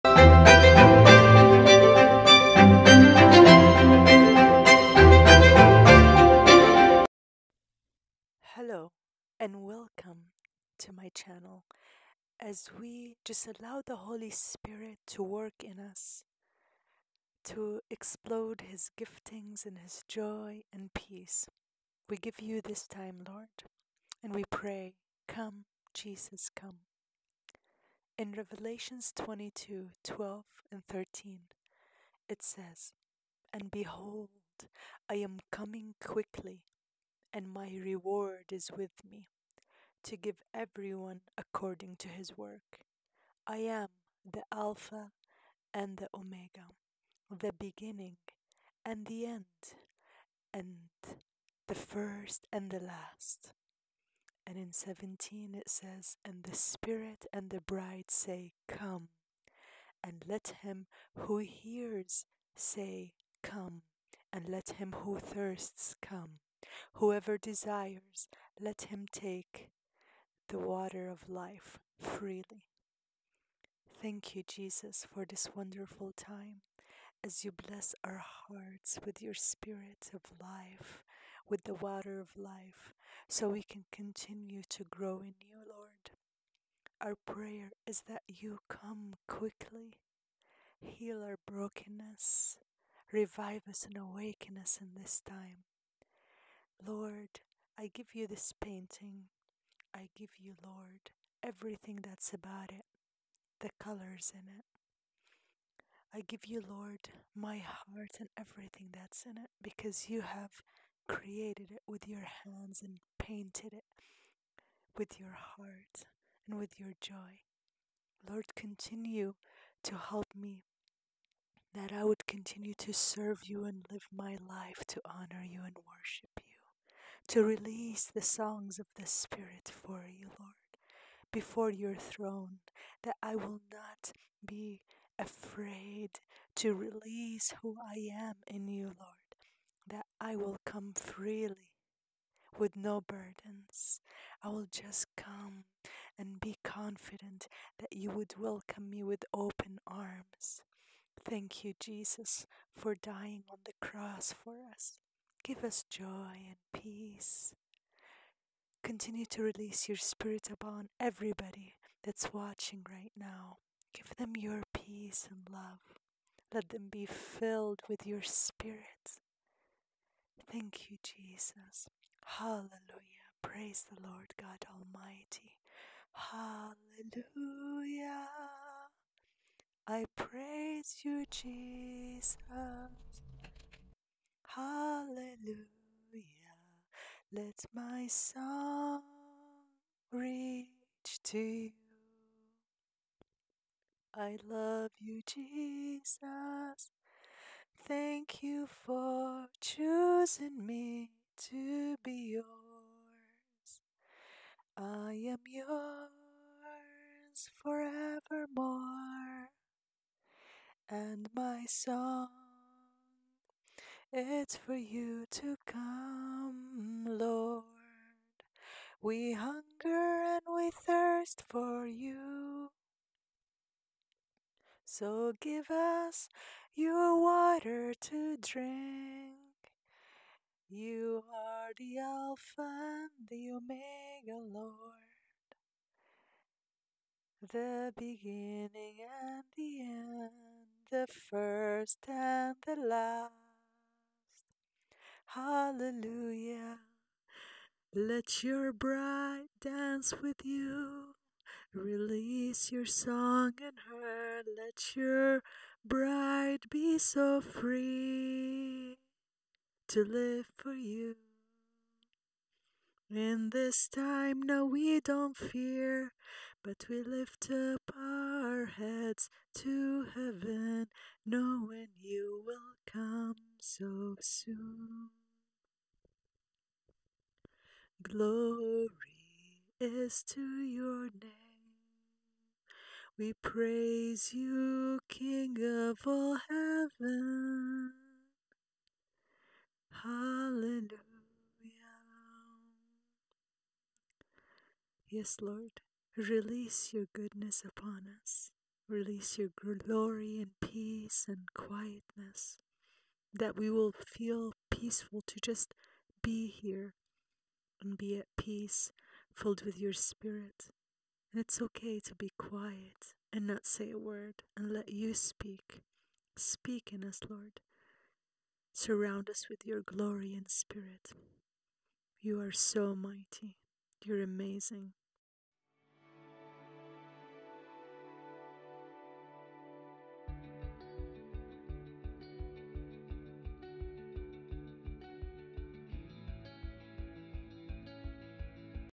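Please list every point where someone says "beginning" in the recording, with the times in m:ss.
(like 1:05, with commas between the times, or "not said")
0:47, 3:57.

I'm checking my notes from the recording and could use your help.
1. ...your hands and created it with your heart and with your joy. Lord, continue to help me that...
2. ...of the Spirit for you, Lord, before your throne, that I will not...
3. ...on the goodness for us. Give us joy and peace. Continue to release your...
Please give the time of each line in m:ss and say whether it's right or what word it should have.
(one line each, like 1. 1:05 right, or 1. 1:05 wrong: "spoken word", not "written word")
1. 1:52 wrong: "painted", not "created"
2. 2:08 right
3. 2:33 wrong: "cross", not "goodness".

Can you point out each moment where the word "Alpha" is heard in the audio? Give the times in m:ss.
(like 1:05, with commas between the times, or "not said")
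0:44, 3:51.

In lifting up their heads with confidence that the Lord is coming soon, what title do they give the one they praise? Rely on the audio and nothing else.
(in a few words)
King of all heaven.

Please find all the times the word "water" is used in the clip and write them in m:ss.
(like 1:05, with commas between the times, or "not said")
1:10, 1:21, 3:47.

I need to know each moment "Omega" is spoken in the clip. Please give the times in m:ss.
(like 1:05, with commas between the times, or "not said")
0:46, 3:53.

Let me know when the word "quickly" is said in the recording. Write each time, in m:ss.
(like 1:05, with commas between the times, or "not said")
0:35, 1:29.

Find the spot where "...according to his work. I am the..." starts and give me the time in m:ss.
0:41.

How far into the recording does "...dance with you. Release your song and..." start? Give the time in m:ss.
4:09.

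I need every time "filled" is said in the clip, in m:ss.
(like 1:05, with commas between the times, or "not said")
2:47, 5:09.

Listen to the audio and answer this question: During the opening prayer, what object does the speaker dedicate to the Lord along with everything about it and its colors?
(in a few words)
This painting.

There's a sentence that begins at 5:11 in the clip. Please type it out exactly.
And it's okay to be quiet and not say a word and let you speak.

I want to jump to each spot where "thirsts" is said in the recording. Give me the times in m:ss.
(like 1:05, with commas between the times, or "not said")
1:05, 3:40.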